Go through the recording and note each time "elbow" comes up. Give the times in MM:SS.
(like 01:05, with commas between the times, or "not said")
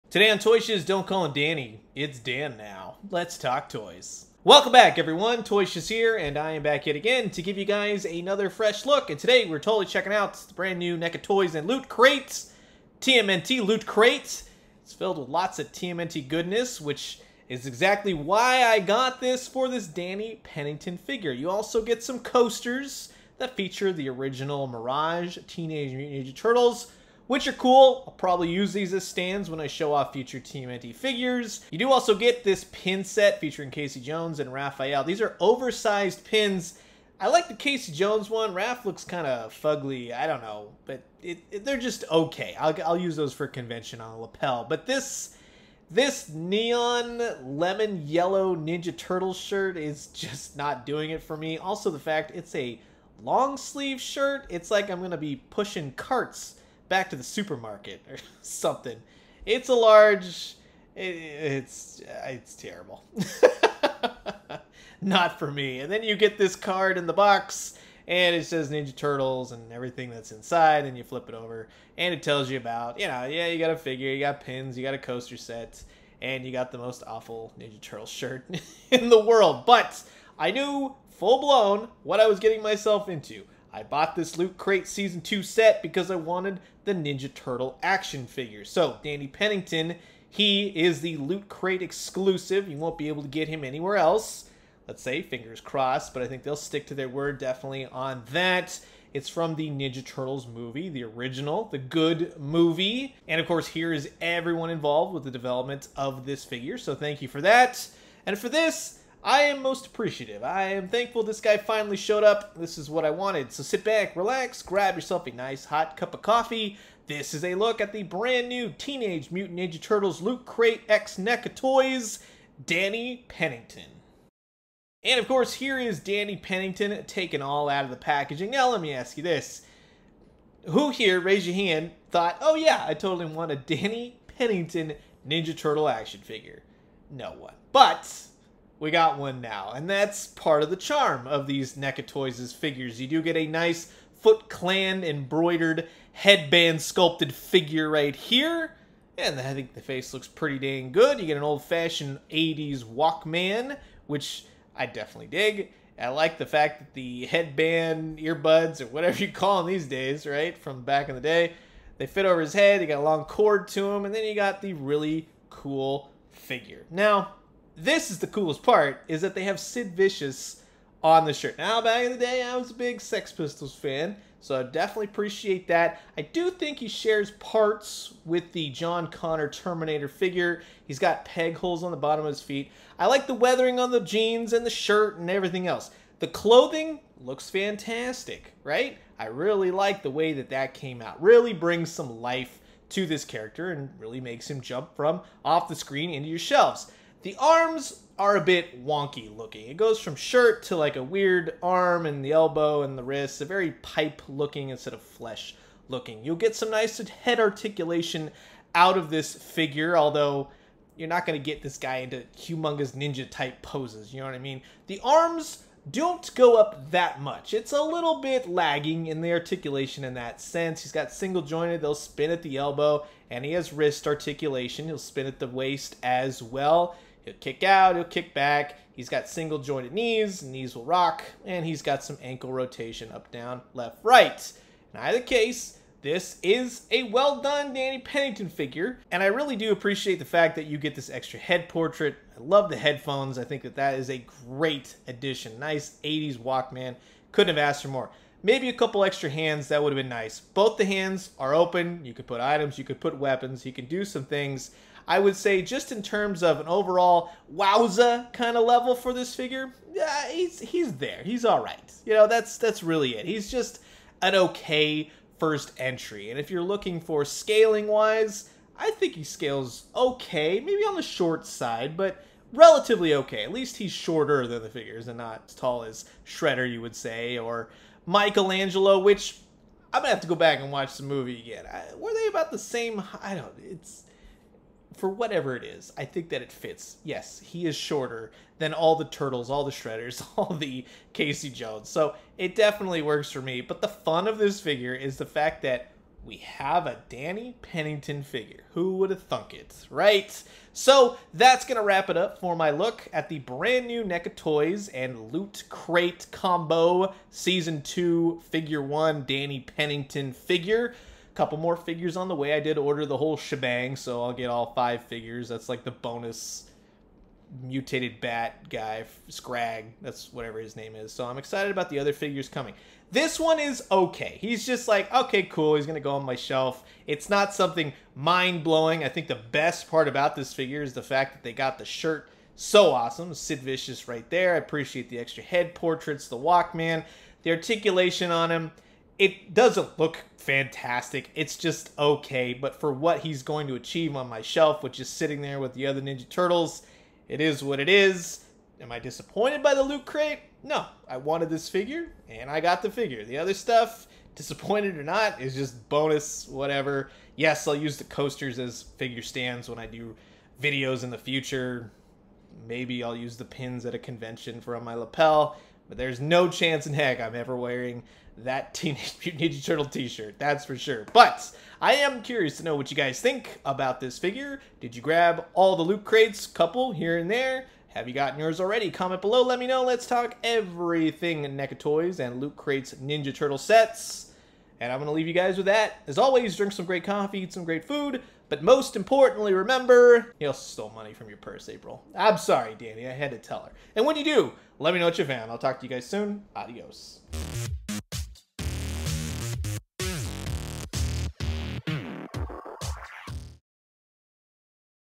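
03:22, 03:42.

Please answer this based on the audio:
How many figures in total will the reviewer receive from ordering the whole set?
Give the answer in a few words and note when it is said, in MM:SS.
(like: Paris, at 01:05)
5, at 05:14.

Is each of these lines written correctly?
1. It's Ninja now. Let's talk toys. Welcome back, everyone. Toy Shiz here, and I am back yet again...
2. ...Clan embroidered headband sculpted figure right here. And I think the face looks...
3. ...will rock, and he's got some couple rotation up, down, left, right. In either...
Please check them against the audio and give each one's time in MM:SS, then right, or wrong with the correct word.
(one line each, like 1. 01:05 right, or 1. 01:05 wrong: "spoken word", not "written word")
1. 00:01 wrong: "Dan", not "Ninja"
2. 02:24 right
3. 03:50 wrong: "ankle", not "couple".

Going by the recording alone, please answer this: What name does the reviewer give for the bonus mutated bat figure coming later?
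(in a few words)
Scragg.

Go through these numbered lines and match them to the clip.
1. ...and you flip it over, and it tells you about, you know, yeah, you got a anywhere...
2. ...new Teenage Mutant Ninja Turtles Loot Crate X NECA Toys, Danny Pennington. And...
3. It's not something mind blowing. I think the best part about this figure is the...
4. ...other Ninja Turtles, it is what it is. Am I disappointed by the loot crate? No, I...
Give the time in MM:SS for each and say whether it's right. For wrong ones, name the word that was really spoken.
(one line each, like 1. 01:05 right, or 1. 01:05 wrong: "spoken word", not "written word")
1. 01:10 wrong: "figure", not "anywhere"
2. 01:58 right
3. 05:27 right
4. 05:45 right.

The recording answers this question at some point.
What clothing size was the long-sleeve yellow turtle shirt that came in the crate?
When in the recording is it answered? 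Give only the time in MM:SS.
00:59.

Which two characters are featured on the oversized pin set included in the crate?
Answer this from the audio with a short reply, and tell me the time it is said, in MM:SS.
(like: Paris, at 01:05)
Casey Jones and Raphael, at 00:33.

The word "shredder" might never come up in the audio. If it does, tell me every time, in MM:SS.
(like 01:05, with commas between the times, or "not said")
04:36, 04:49.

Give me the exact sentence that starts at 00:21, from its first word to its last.
You also get some coasters that feature the original Mirage, Teenage Mutant Ninja Turtles, which are cool.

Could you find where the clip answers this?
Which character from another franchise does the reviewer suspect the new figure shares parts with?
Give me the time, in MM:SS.
02:58.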